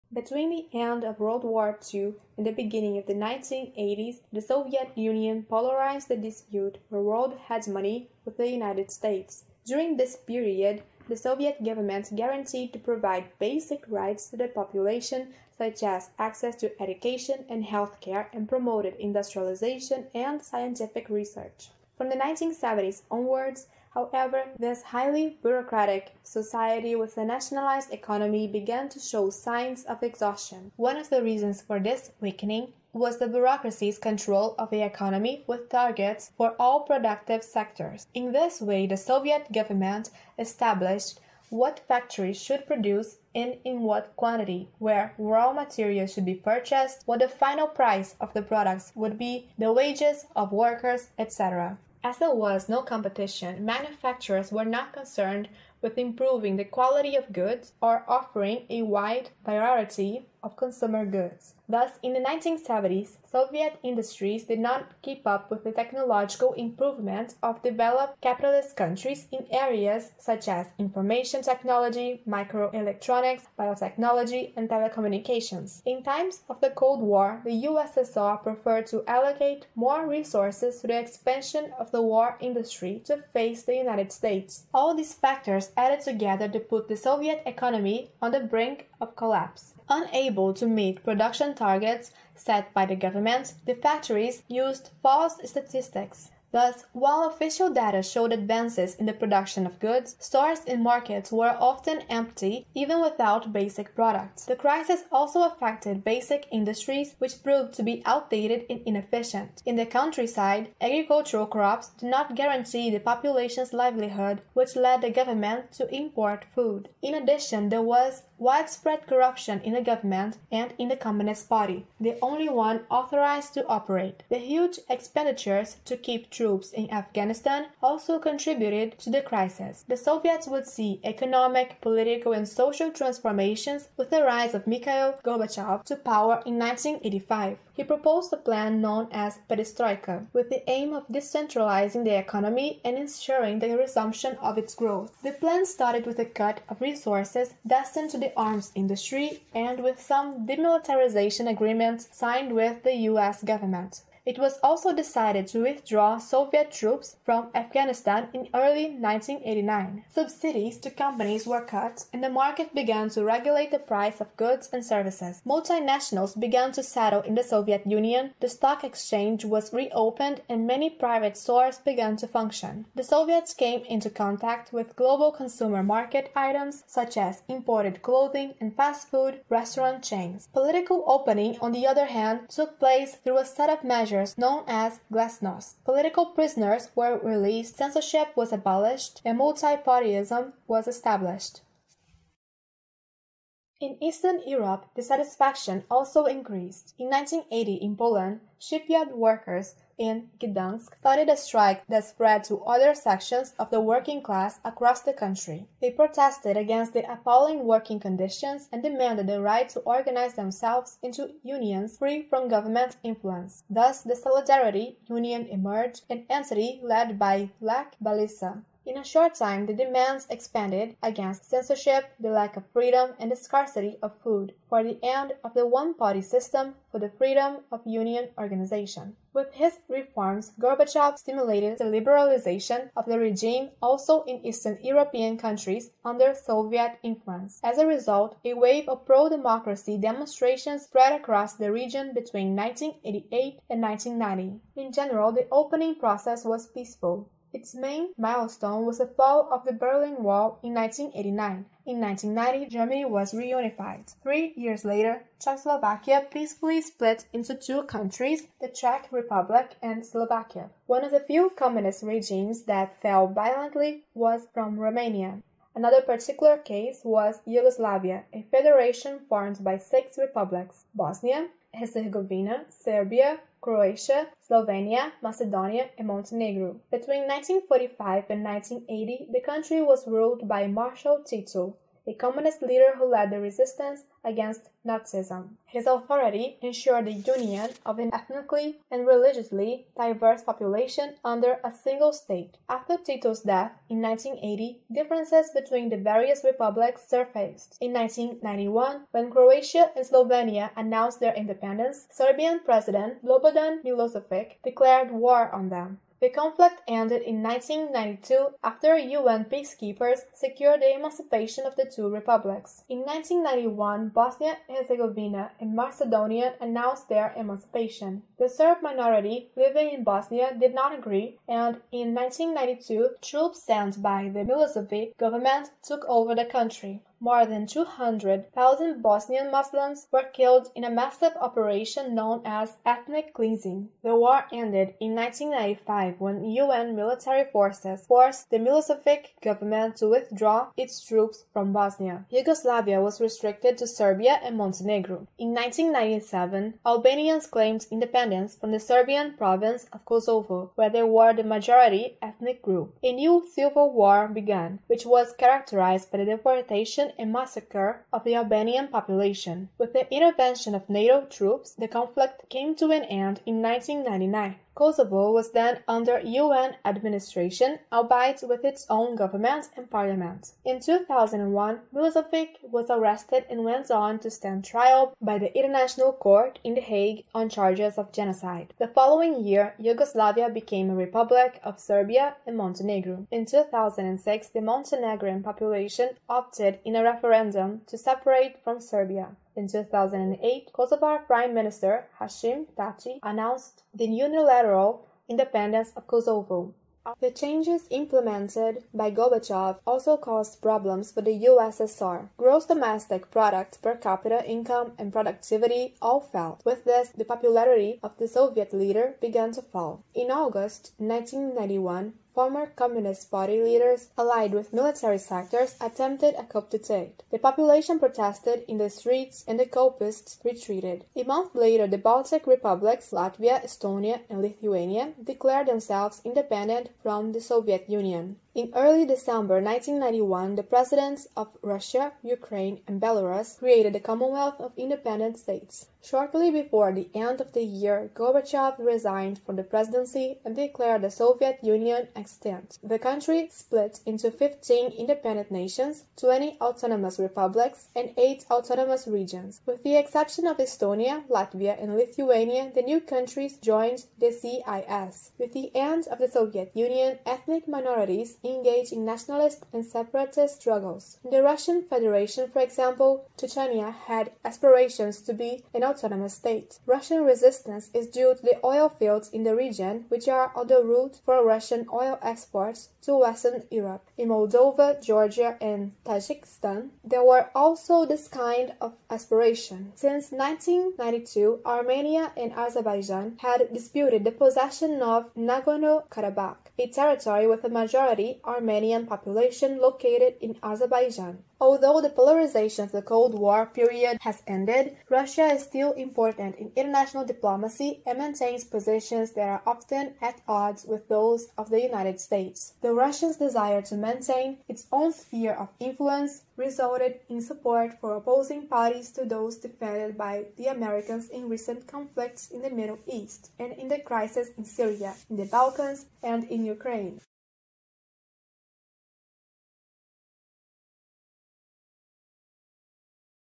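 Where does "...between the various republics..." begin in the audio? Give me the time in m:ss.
4:55.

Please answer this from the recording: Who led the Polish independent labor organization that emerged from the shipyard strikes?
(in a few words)
Lech Walesa.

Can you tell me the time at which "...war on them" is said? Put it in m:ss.
5:05.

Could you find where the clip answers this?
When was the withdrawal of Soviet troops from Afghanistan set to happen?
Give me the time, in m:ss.
2:38.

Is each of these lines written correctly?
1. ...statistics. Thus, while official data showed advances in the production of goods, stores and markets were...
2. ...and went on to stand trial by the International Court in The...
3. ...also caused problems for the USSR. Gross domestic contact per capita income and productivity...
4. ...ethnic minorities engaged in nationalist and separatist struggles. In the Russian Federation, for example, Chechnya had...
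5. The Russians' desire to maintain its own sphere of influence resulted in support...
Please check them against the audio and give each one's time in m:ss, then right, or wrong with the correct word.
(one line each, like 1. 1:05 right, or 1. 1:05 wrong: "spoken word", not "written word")
1. 1:35 right
2. 6:13 right
3. 6:39 wrong: "product", not "contact"
4. 7:37 right
5. 8:22 right.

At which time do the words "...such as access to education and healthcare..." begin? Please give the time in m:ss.
0:15.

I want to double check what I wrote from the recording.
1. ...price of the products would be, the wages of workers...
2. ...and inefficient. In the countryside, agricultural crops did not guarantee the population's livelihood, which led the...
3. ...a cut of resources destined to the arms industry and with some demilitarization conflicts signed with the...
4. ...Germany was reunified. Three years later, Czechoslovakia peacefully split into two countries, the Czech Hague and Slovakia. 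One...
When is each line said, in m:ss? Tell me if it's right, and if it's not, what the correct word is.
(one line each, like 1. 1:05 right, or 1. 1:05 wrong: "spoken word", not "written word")
1. 0:47 right
2. 1:48 right
3. 2:26 wrong: "agreements", not "conflicts"
4. 4:12 wrong: "Republic", not "Hague".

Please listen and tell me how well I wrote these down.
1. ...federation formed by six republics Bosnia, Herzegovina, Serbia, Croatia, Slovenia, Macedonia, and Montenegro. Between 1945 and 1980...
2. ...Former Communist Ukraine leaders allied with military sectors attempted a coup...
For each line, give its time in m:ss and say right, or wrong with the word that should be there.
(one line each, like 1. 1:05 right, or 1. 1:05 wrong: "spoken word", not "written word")
1. 4:28 right
2. 6:52 wrong: "Party", not "Ukraine".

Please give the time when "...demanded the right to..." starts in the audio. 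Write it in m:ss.
3:28.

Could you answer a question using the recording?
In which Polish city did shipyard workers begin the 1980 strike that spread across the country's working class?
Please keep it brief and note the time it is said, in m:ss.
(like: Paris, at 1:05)
Gdansk, at 3:20.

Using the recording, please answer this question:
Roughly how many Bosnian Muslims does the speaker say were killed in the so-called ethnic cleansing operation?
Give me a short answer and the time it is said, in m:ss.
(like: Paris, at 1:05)
200,000, at 5:27.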